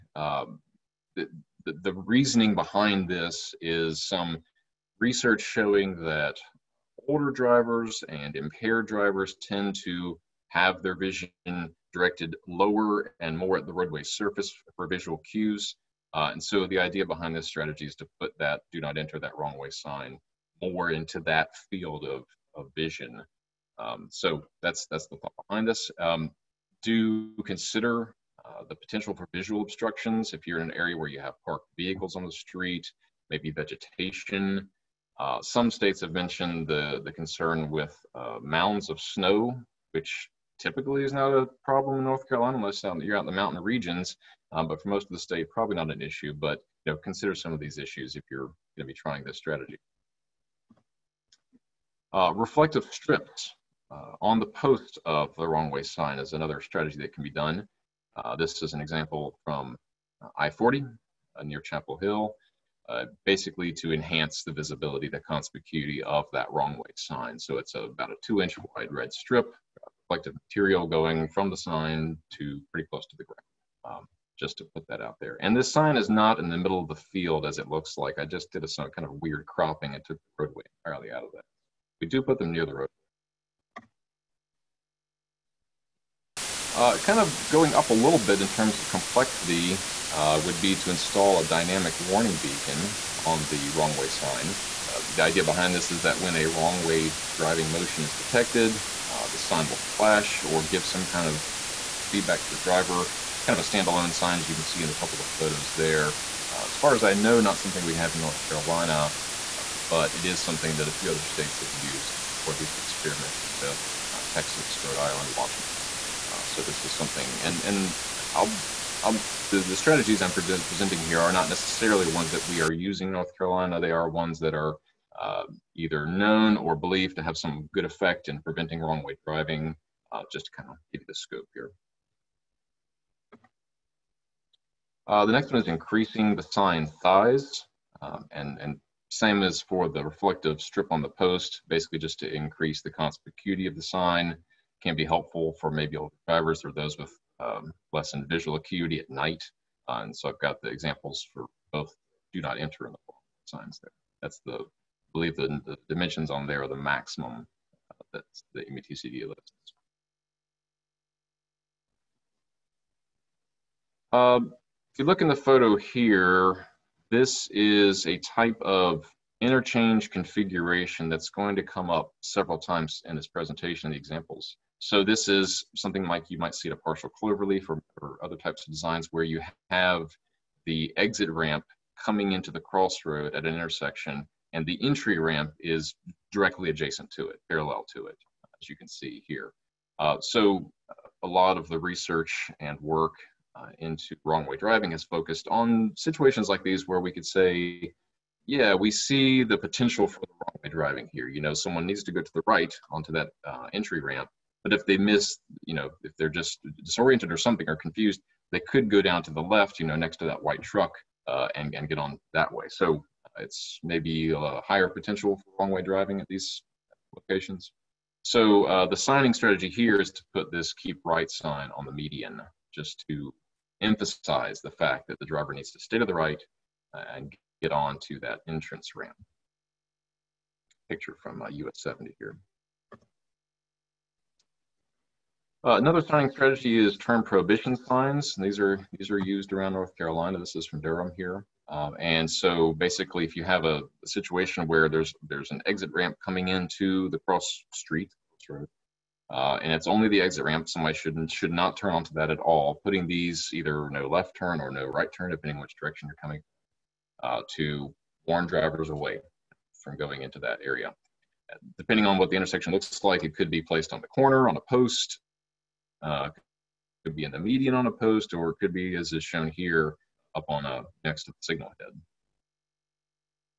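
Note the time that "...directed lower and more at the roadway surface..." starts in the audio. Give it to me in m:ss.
0:11.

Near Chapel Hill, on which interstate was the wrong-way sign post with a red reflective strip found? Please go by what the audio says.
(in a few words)
I-40.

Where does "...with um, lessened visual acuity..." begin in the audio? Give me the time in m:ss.
2:26.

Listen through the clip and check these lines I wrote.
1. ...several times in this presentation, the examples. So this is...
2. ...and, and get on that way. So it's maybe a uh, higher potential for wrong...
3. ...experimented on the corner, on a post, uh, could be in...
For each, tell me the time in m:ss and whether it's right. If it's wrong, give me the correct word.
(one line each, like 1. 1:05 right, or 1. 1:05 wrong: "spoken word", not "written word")
1. 2:52 right
2. 3:31 right
3. 4:23 wrong: "placed", not "experimented".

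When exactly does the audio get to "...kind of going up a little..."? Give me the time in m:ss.
1:26.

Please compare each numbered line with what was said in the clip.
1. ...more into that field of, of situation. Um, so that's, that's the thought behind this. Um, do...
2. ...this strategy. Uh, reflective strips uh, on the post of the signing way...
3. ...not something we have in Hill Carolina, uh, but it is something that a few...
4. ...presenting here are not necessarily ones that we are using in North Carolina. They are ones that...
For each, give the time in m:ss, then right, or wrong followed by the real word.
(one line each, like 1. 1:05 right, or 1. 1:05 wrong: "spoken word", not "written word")
1. 0:20 wrong: "vision", not "situation"
2. 0:49 wrong: "wrong", not "signing"
3. 1:47 wrong: "North", not "Hill"
4. 2:00 right.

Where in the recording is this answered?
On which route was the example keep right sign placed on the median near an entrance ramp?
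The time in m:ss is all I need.
3:51.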